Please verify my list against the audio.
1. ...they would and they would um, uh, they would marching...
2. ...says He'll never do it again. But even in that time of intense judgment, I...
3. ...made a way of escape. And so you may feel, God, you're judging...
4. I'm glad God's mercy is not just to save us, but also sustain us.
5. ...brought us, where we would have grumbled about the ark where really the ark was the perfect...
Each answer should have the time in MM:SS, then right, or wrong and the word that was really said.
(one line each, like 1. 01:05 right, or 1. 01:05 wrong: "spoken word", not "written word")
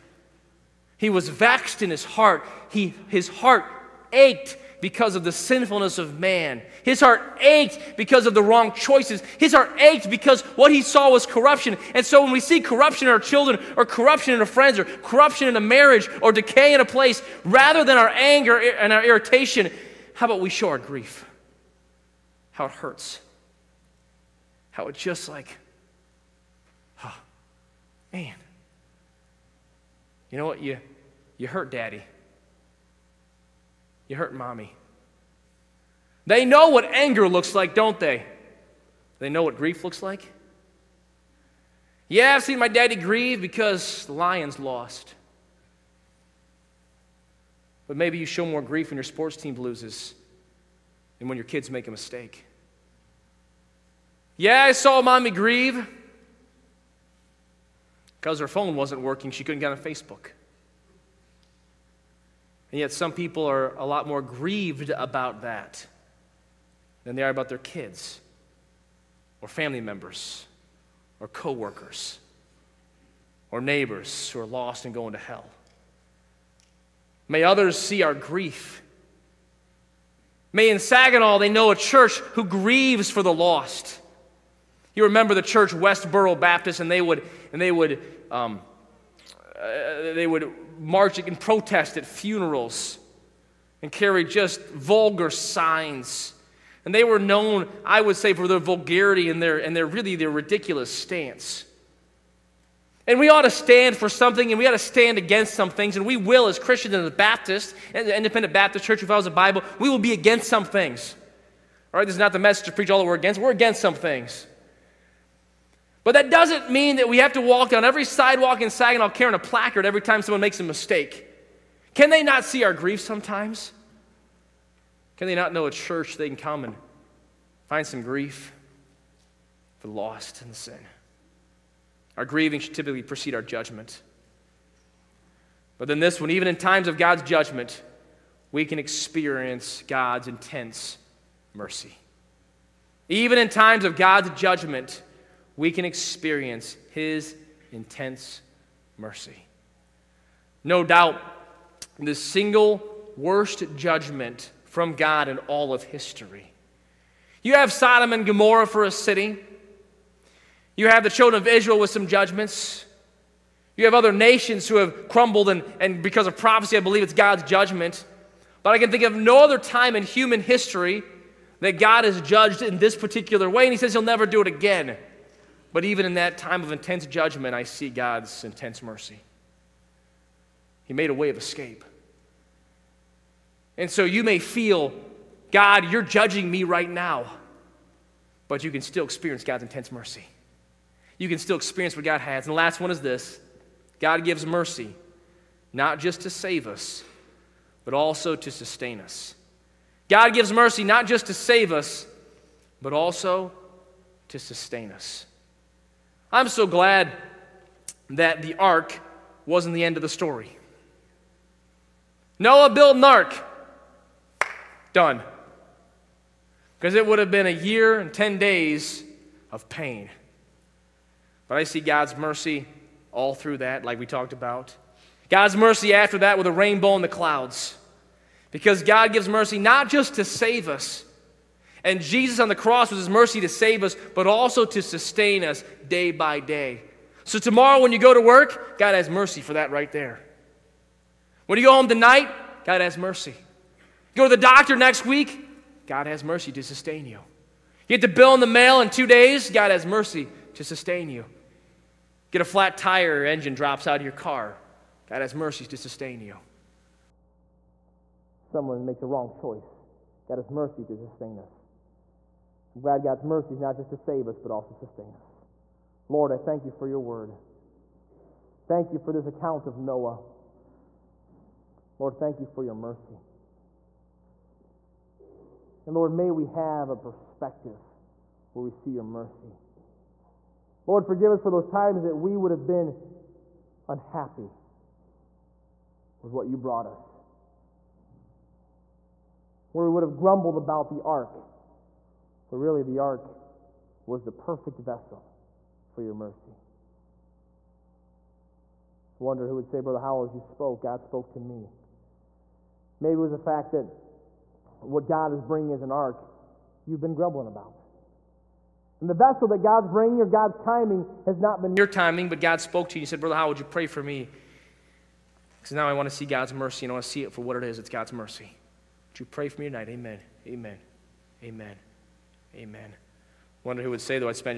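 1. 01:26 right
2. 02:53 right
3. 03:00 right
4. 04:22 right
5. 04:46 right.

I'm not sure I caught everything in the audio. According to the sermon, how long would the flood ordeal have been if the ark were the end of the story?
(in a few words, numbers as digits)
a year and 10 days.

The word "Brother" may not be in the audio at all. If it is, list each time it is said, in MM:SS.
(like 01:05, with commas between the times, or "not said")
04:59, 05:13.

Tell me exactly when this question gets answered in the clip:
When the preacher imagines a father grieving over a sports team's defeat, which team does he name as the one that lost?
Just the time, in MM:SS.
00:44.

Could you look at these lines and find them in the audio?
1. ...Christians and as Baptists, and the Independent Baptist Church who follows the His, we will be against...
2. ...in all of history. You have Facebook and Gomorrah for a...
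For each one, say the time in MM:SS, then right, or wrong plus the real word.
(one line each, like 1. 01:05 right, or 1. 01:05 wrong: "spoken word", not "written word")
1. 01:46 wrong: "Bible", not "His"
2. 02:35 wrong: "Sodom", not "Facebook".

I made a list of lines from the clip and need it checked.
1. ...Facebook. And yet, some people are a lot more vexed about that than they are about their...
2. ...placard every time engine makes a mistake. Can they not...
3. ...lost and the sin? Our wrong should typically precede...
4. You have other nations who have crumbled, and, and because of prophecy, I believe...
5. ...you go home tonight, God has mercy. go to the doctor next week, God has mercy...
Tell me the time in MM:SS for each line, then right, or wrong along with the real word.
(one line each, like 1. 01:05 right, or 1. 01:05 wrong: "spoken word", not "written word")
1. 00:59 wrong: "grieved", not "vexed"
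2. 01:59 wrong: "someone", not "engine"
3. 02:09 wrong: "grieving", not "wrong"
4. 02:43 right
5. 04:01 right.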